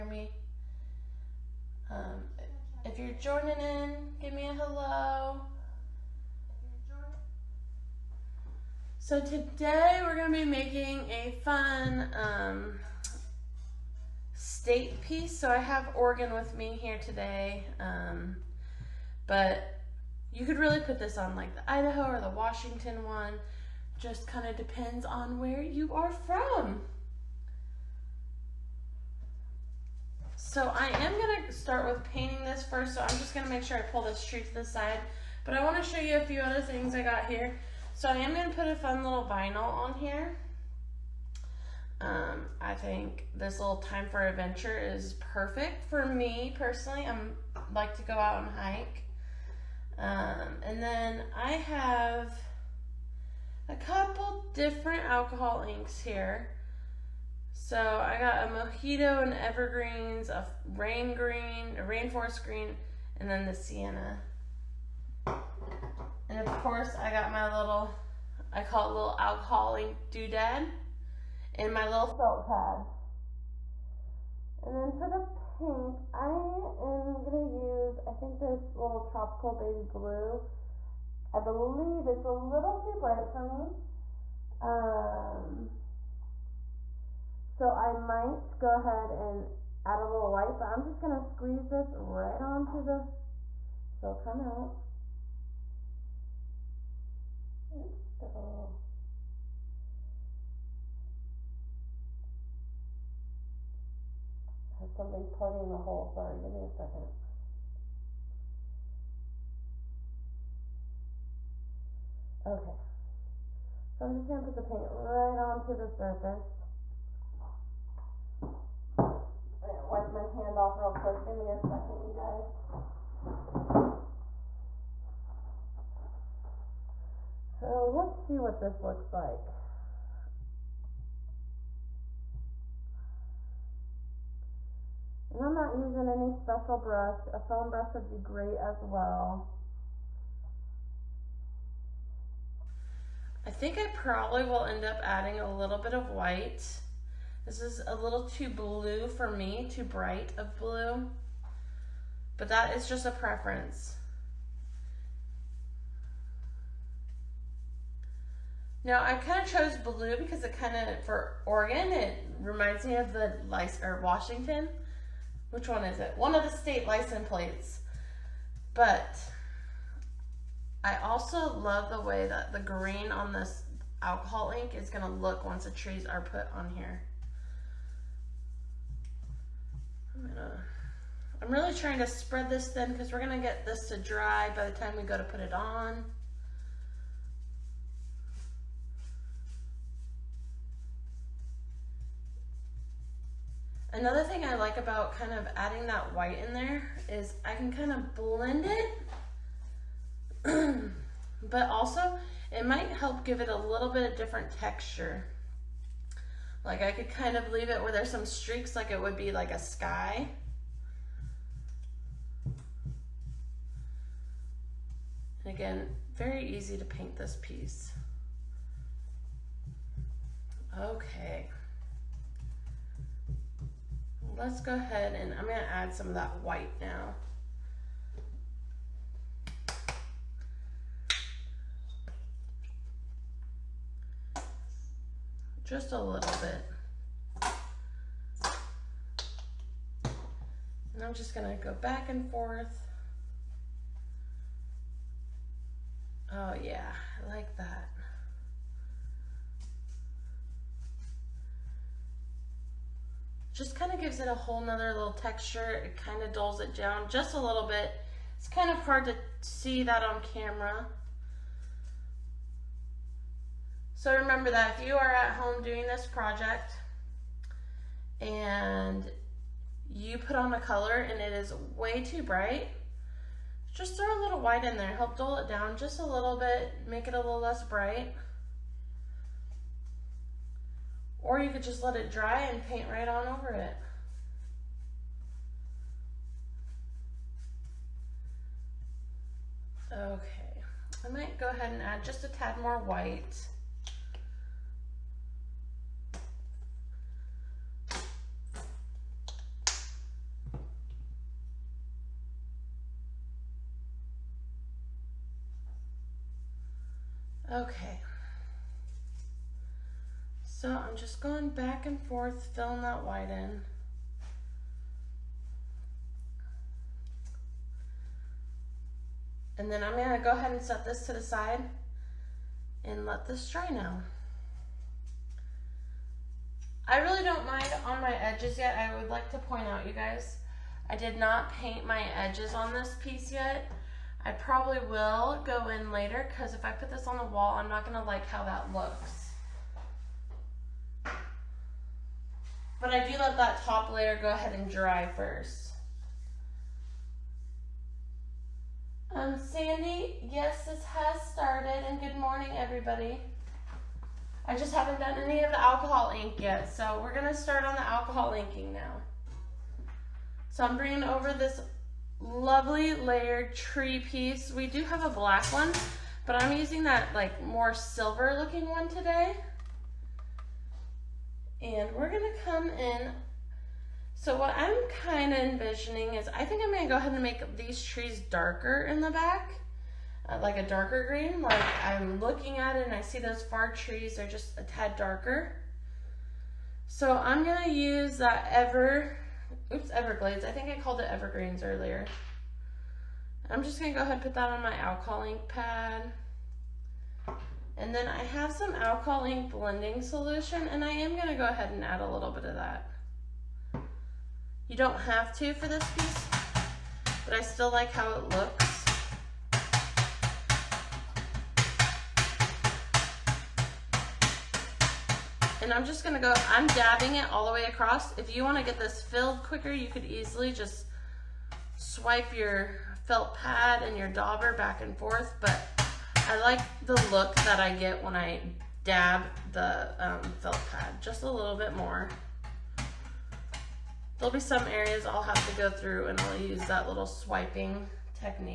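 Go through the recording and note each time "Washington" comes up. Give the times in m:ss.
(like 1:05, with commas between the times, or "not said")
0:22, 2:44.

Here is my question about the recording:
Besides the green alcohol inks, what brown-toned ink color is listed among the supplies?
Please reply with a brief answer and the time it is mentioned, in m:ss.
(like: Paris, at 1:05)
sienna, at 1:03.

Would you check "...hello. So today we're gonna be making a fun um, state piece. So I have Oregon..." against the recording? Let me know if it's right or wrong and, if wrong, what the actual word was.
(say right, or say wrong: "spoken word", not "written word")
right.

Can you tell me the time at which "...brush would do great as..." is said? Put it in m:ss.
2:17.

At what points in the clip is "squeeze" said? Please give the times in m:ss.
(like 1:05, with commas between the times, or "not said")
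1:31.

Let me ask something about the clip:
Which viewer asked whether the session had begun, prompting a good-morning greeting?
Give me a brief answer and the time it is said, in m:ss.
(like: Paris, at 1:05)
Sandy, at 5:49.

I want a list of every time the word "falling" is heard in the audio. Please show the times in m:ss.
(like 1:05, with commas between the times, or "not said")
not said.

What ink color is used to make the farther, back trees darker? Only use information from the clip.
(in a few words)
Everglades.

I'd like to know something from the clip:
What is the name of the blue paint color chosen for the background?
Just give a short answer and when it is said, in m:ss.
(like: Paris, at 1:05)
tropical baby blue, at 1:19.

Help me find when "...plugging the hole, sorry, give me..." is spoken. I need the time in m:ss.
1:45.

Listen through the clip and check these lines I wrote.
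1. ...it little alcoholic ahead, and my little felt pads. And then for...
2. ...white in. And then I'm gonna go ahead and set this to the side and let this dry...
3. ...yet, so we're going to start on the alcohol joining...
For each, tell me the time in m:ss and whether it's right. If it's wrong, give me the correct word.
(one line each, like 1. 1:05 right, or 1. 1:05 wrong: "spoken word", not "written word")
1. 1:08 wrong: "doodad", not "ahead"
2. 5:13 right
3. 5:56 wrong: "inking", not "joining".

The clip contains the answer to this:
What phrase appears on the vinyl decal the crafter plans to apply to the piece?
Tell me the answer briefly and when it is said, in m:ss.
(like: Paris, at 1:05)
time for adventure, at 0:43.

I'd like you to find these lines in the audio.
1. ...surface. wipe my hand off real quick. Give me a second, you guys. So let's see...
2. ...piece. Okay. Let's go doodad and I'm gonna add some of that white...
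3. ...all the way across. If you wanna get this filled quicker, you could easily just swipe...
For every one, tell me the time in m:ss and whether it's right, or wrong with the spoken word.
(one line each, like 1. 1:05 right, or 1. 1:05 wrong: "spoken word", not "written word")
1. 1:55 right
2. 3:37 wrong: "ahead", not "doodad"
3. 6:57 right.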